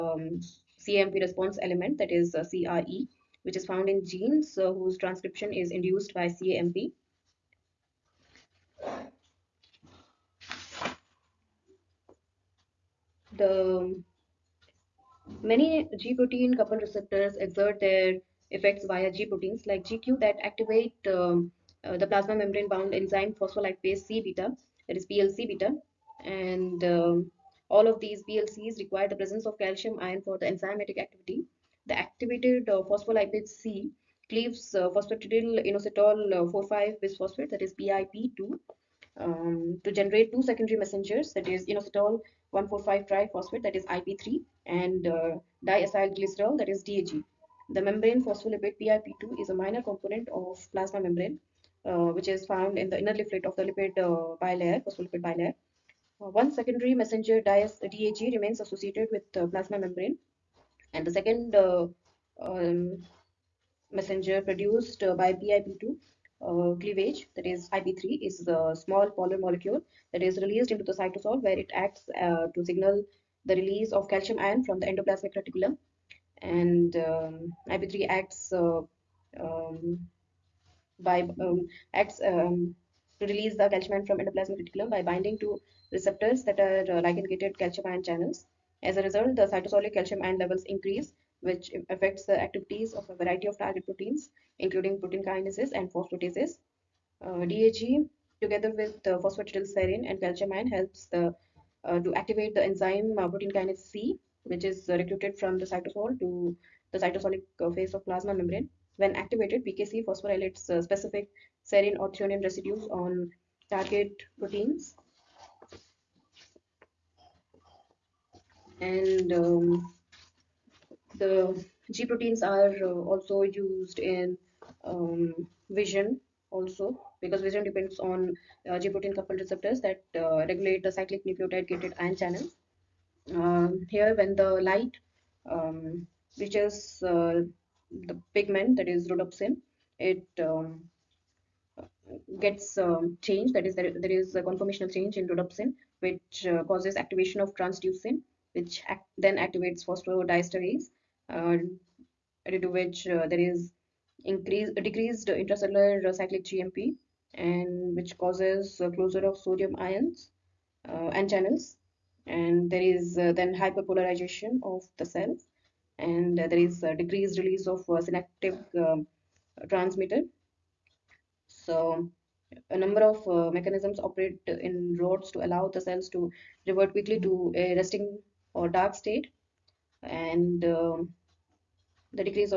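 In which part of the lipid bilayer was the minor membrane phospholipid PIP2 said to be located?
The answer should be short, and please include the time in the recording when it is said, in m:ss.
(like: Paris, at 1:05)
Inner leaflet, at 0:52.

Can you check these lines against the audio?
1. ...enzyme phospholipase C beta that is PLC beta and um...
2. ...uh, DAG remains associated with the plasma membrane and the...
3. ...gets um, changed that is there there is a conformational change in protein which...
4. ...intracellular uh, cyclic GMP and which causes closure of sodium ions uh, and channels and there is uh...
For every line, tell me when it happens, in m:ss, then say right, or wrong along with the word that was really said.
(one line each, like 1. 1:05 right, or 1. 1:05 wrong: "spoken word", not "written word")
1. 0:22 right
2. 0:57 right
3. 2:22 wrong: "rhodopsin", not "protein"
4. 2:35 right.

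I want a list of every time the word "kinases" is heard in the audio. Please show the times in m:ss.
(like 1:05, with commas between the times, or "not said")
1:35, 1:43.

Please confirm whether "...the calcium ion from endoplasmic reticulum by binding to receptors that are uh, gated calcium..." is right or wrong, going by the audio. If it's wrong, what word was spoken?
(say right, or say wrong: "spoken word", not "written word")
right.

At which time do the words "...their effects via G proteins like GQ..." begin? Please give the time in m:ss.
0:17.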